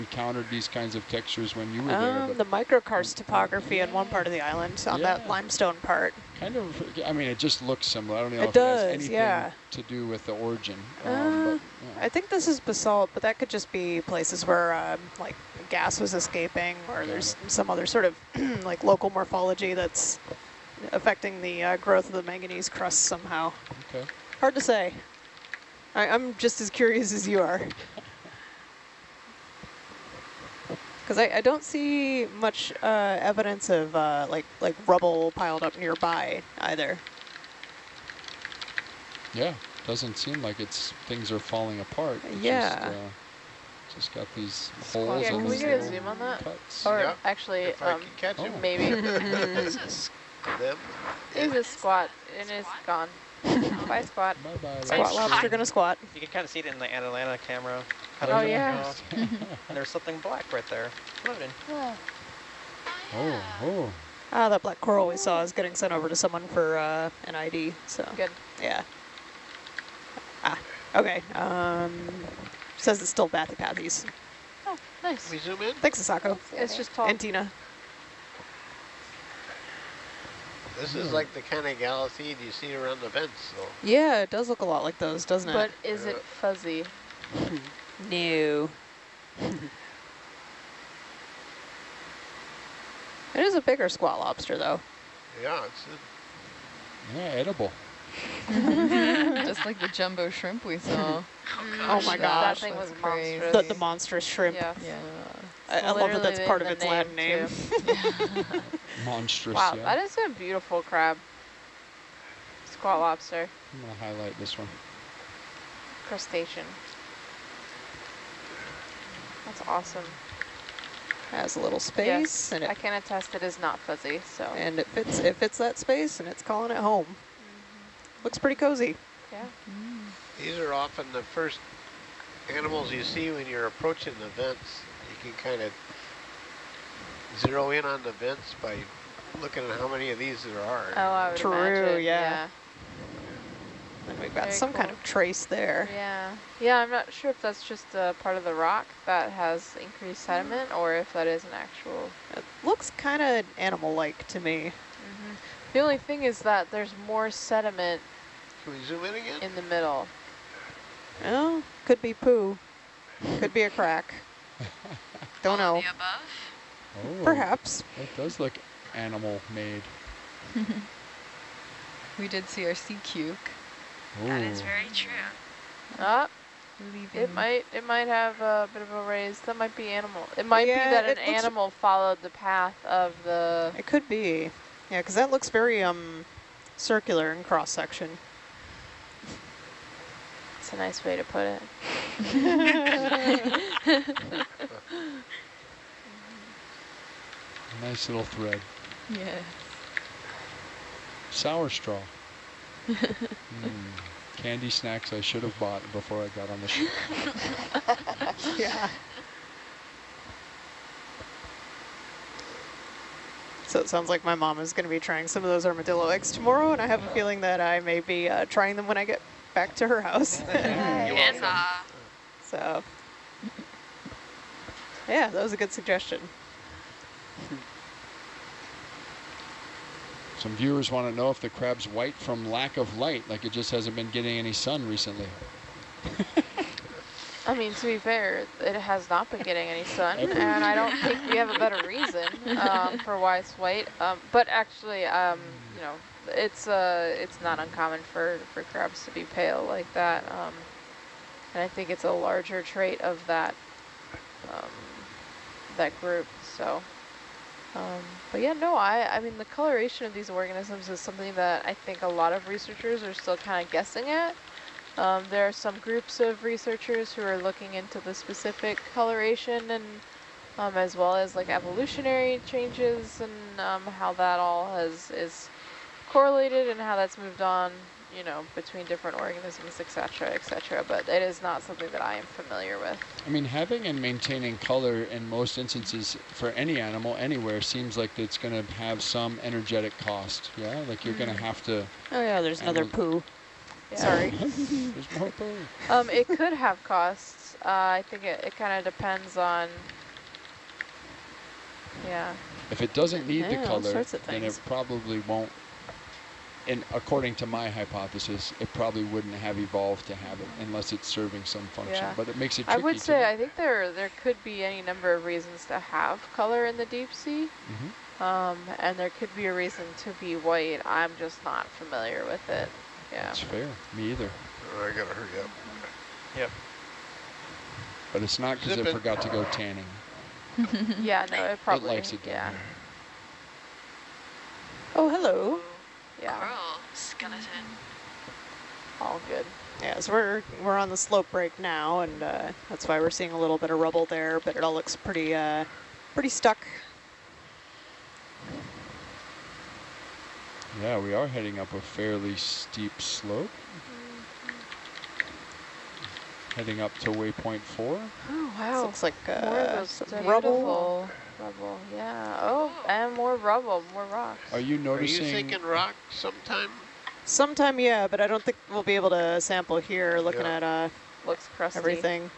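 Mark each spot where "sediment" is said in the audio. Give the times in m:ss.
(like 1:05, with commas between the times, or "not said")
2:30, 2:37.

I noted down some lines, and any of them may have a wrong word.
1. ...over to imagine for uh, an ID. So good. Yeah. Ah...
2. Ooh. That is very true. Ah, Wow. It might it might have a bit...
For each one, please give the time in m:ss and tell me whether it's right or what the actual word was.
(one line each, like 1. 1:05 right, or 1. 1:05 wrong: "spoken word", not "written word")
1. 1:05 wrong: "someone", not "imagine"
2. 2:54 wrong: "Leaving", not "Wow".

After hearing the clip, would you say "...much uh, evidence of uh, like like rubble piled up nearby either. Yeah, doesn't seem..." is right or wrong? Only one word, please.
right.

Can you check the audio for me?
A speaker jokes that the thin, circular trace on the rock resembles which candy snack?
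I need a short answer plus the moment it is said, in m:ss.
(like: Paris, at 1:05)
Sour straw, at 3:21.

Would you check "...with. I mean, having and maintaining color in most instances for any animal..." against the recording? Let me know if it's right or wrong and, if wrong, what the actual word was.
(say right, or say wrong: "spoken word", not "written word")
right.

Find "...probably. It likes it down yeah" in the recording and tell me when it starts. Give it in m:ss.
5:31.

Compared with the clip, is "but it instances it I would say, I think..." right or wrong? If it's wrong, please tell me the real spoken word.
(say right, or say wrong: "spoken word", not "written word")
wrong: "makes", not "instances".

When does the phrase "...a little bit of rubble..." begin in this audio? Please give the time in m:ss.
5:43.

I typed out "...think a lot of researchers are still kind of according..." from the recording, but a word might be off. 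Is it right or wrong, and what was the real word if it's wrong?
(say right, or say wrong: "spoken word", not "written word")
wrong: "guessing", not "according".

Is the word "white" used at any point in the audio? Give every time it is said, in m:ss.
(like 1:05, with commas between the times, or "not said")
3:51, 4:03, 5:20.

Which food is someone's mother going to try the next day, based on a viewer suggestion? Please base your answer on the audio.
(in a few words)
Armadillo eggs.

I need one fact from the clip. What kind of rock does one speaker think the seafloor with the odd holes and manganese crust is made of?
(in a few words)
Basalt.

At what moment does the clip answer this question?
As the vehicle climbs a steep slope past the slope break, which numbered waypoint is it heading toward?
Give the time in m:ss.
5:57.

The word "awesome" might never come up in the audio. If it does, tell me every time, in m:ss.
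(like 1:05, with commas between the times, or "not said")
1:59.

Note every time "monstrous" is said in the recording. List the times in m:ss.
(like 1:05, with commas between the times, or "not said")
1:43, 1:49.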